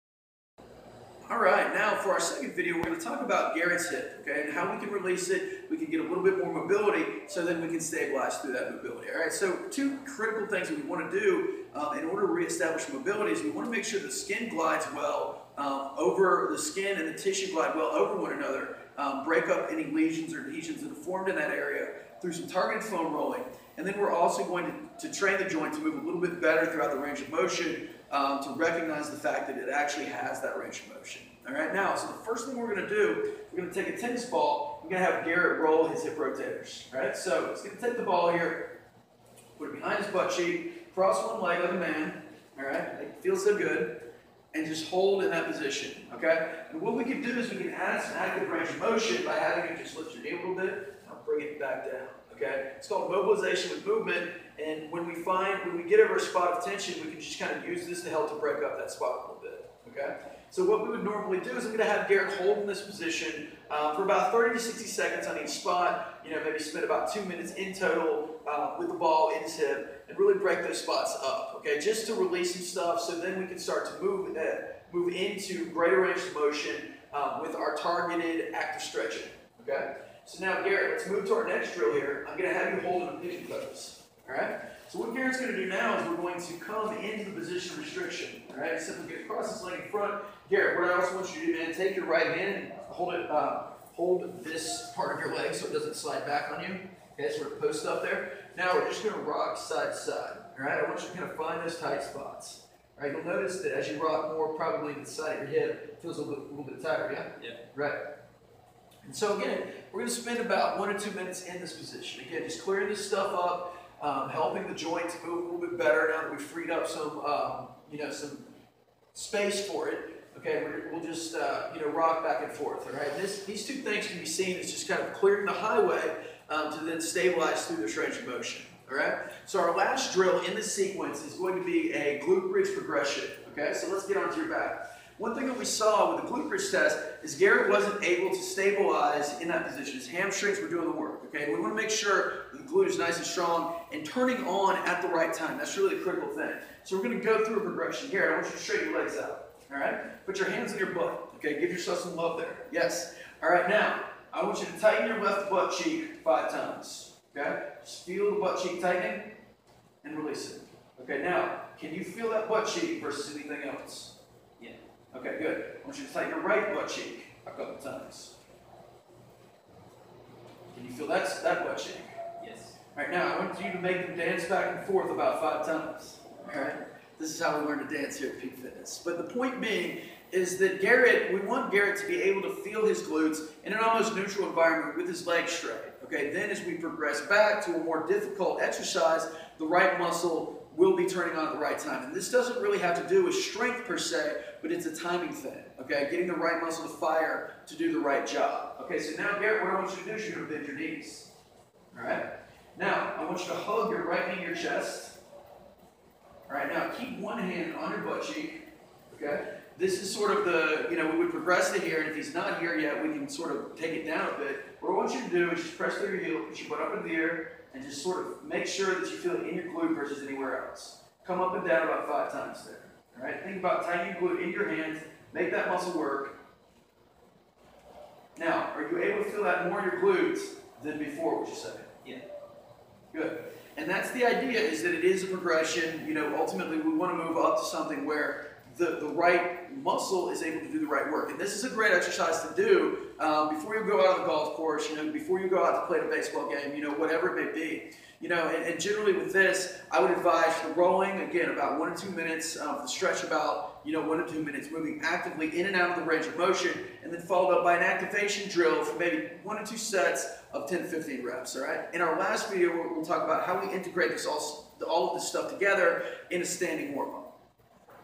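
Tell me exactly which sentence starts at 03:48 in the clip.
Now, are you able to feel that more in your glutes than before, would you say?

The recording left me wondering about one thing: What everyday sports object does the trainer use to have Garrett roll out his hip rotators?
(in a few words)
tennis ball.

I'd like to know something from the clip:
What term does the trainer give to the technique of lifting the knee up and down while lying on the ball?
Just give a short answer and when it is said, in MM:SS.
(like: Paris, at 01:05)
mobilization with movement, at 00:53.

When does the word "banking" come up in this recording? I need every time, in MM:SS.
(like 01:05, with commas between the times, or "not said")
not said.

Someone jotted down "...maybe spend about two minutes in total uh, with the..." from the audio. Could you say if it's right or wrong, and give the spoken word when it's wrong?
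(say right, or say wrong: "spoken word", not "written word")
right.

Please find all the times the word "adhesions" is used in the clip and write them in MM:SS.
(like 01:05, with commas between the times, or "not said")
00:20.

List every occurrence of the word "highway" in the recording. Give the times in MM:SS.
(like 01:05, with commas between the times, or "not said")
02:05.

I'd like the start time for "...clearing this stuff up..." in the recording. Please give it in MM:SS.
01:52.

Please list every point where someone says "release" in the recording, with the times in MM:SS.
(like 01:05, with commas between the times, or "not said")
00:04, 01:12, 02:40.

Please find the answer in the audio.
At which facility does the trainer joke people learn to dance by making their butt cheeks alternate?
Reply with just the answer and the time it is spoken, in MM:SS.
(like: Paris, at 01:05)
Peak Fitness, at 02:58.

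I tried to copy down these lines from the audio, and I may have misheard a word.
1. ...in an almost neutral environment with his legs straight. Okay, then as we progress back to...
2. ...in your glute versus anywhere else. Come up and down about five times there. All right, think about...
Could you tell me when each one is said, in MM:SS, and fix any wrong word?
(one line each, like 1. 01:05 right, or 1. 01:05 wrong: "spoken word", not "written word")
1. 03:03 right
2. 03:39 right.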